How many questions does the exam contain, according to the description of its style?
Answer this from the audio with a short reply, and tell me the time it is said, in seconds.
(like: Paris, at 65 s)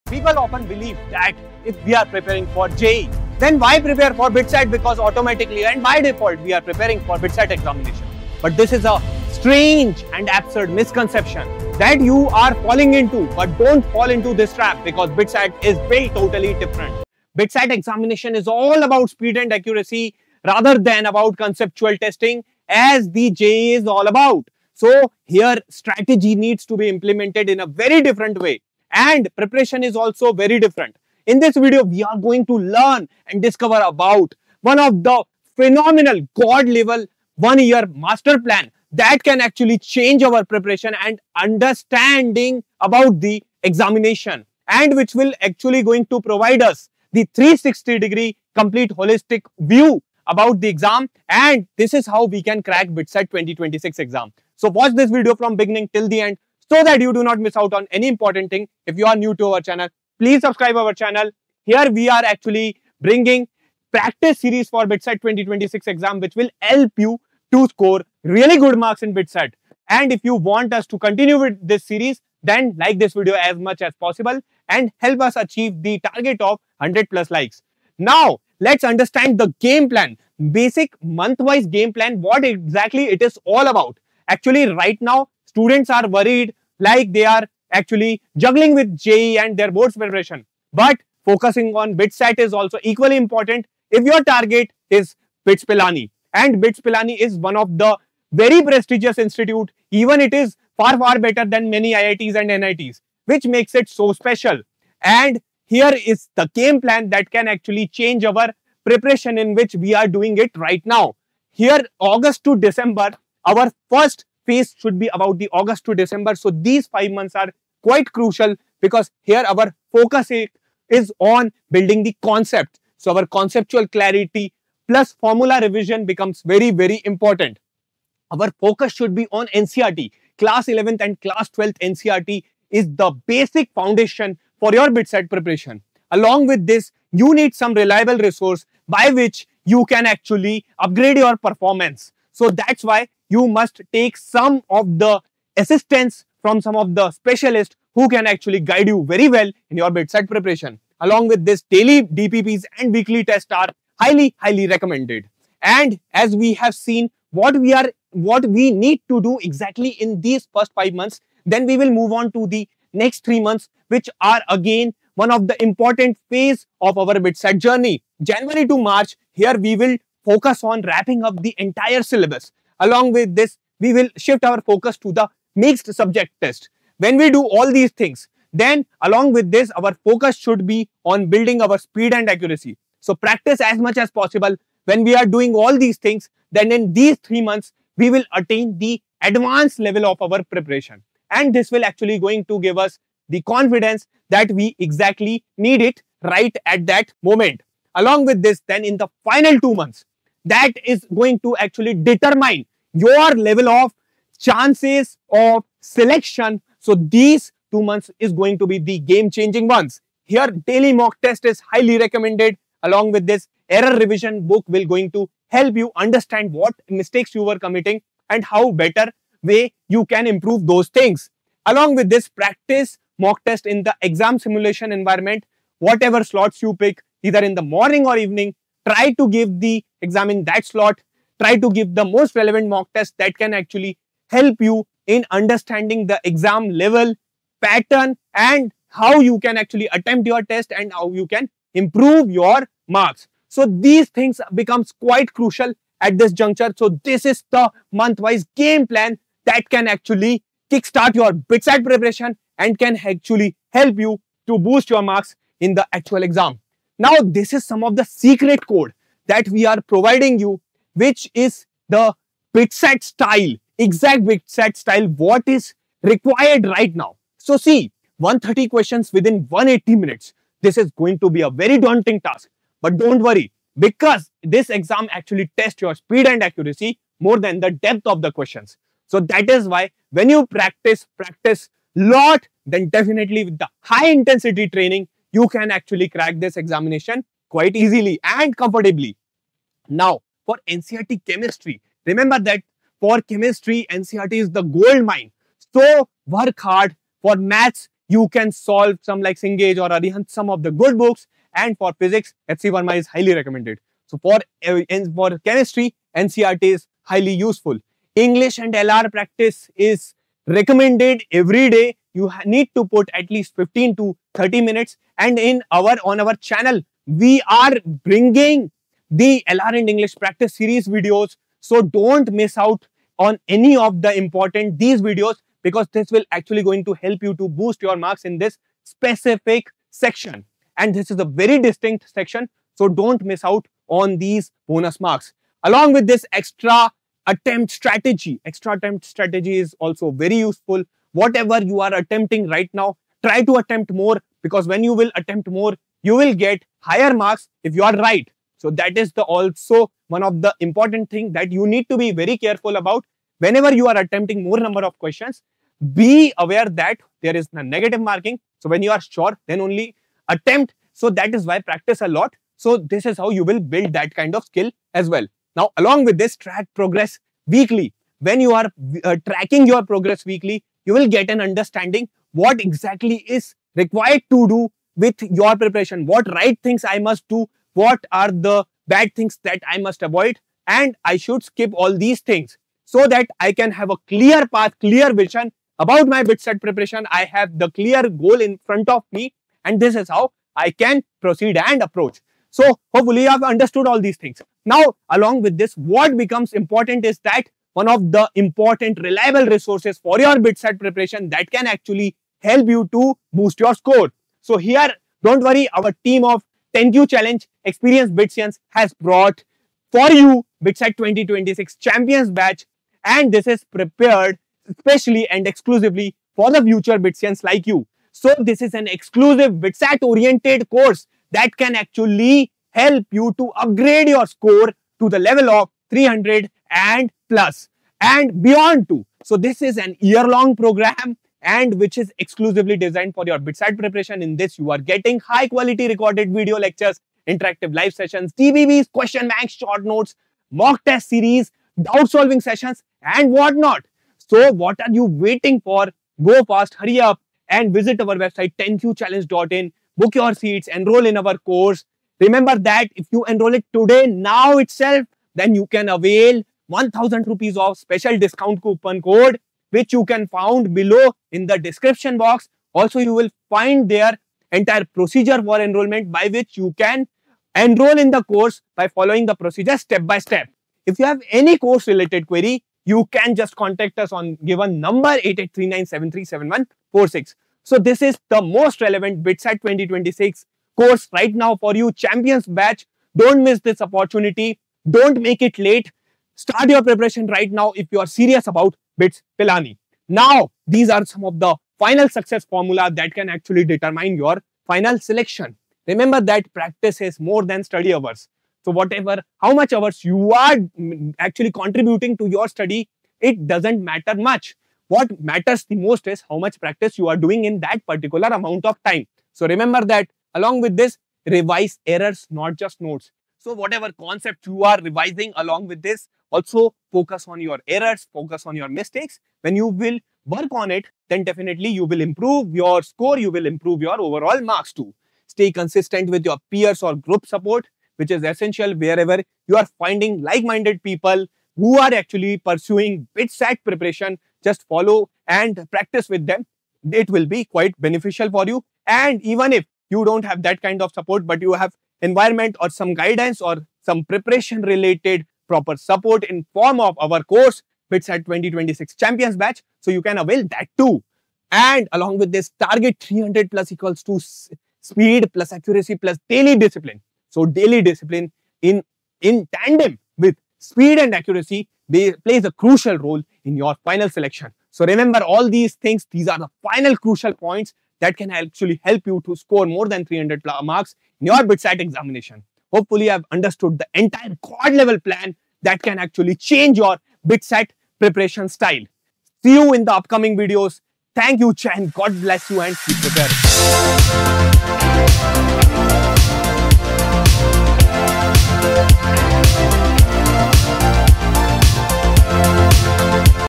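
130, at 268 s.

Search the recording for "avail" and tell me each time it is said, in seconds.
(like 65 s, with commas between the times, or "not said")
455 s, 550 s.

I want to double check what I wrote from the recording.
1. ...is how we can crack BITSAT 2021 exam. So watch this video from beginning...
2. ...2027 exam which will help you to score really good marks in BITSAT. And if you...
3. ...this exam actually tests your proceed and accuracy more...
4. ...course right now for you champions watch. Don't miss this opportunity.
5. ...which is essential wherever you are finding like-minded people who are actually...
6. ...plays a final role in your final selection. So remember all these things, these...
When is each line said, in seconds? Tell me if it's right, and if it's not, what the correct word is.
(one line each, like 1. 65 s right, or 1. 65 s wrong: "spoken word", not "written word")
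1. 51 s wrong: "2026", not "2021"
2. 65 s wrong: "2026", not "2027"
3. 274 s wrong: "speed", not "proceed"
4. 480 s wrong: "batch", not "watch"
5. 527 s right
6. 562 s wrong: "crucial", not "final".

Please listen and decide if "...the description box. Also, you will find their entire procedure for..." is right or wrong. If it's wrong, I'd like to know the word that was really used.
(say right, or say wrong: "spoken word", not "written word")
right.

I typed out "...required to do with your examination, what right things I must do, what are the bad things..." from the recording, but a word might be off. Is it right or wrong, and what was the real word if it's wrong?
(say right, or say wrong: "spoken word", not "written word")
wrong: "preparation", not "examination".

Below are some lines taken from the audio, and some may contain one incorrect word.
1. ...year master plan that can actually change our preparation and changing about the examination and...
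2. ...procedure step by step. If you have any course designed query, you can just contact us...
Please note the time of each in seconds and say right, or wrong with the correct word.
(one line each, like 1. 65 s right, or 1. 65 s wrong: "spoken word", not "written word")
1. 37 s wrong: "understanding", not "changing"
2. 469 s wrong: "related", not "designed".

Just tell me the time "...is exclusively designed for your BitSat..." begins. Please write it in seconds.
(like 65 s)
431 s.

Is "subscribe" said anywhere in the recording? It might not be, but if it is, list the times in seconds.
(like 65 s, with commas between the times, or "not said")
60 s.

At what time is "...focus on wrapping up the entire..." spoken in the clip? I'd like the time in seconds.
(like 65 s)
170 s.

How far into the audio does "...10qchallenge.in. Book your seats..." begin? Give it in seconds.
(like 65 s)
448 s.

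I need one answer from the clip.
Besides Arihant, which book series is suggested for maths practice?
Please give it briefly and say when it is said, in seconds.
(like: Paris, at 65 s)
Cengage, at 299 s.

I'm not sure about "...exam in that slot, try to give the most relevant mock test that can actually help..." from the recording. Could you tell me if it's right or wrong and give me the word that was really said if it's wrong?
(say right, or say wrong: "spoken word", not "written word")
right.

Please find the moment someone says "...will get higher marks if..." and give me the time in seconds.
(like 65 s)
346 s.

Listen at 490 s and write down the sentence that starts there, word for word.
Now, these are some of the final success formula that can actually determine your final selection.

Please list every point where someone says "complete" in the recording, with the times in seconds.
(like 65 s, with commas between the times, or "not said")
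48 s.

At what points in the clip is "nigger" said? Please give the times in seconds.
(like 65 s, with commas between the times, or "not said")
not said.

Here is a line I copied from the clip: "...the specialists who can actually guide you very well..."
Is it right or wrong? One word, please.
right.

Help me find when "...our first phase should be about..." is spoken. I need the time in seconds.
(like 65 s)
113 s.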